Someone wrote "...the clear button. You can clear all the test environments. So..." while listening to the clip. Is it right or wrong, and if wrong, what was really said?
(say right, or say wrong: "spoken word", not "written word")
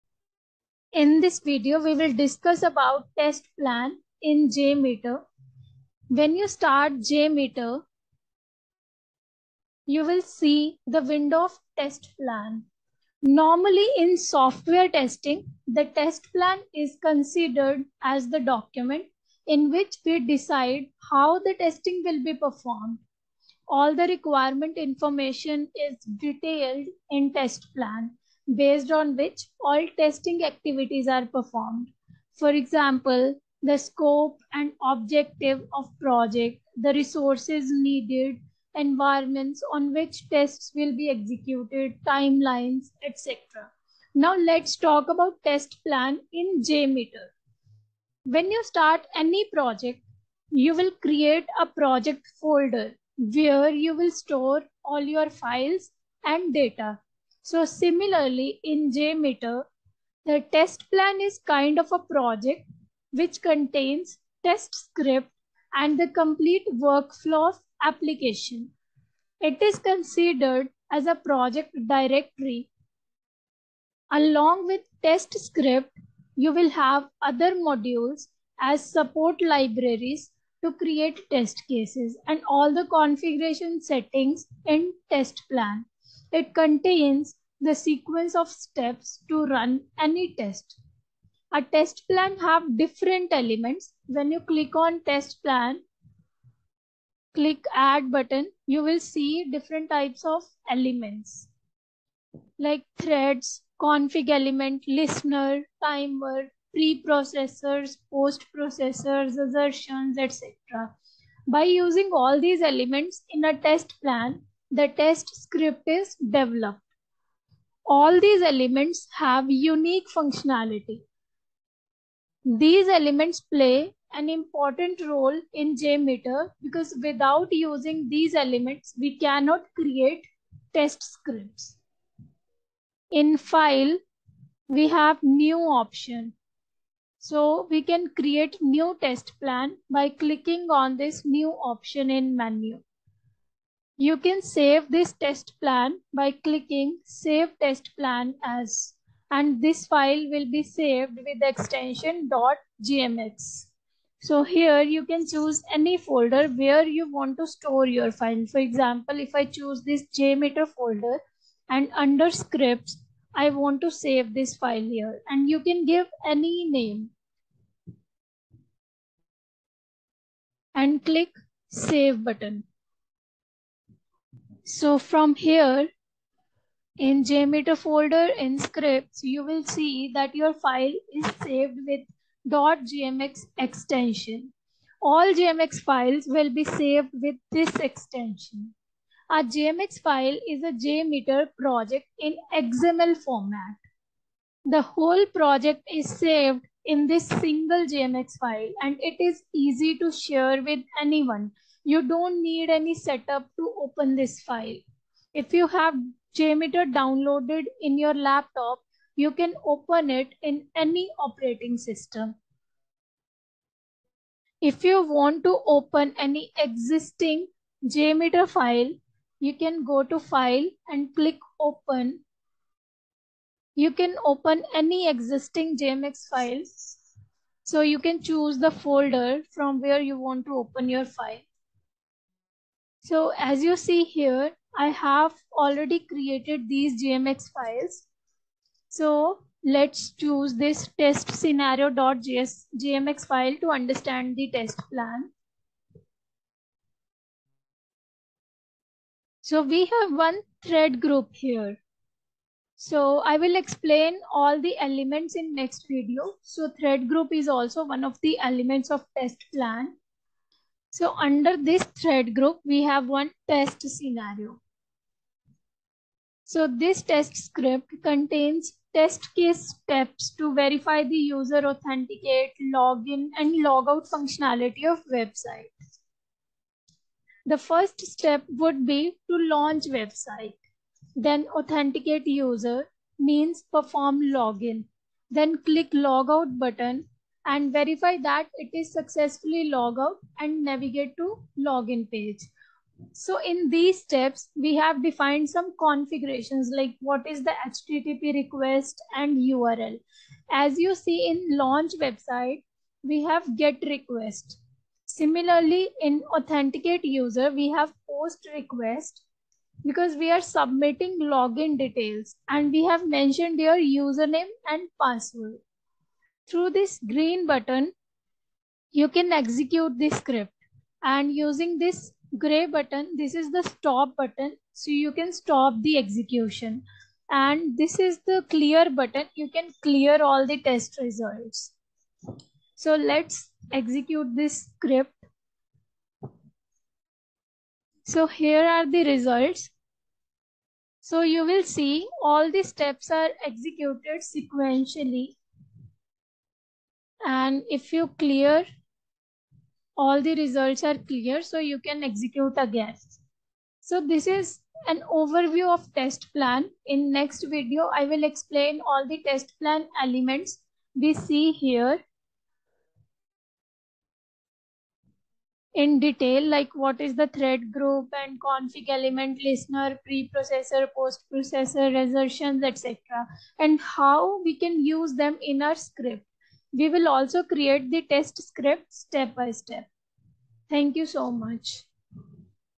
wrong: "results", not "environments".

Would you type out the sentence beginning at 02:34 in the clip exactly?
So here you can choose any folder where you want to store your file.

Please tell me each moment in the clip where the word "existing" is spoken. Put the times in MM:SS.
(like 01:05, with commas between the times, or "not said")
03:36, 03:45.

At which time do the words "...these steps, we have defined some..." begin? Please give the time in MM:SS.
04:53.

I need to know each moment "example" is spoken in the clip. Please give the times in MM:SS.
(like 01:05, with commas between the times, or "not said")
00:32, 02:38.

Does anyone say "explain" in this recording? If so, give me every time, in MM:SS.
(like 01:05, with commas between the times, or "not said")
04:13, 05:58.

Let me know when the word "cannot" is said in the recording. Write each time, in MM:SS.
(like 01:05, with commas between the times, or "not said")
02:09.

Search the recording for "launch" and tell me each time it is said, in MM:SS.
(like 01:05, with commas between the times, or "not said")
04:39, 05:01.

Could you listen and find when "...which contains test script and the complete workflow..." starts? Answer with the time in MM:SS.
01:03.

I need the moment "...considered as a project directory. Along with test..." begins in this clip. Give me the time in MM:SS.
01:09.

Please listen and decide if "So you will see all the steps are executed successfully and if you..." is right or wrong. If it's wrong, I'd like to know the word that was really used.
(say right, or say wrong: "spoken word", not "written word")
wrong: "sequentially", not "successfully".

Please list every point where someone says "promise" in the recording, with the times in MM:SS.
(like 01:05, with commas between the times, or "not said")
not said.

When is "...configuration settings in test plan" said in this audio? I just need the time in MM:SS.
01:22.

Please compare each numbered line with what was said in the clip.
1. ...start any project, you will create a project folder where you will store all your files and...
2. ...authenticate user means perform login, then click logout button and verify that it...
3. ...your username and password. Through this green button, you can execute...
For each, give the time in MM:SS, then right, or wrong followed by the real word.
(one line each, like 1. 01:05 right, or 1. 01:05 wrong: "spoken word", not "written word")
1. 00:48 right
2. 04:41 right
3. 05:13 right.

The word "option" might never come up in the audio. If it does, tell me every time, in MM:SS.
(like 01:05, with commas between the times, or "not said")
02:15, 02:21.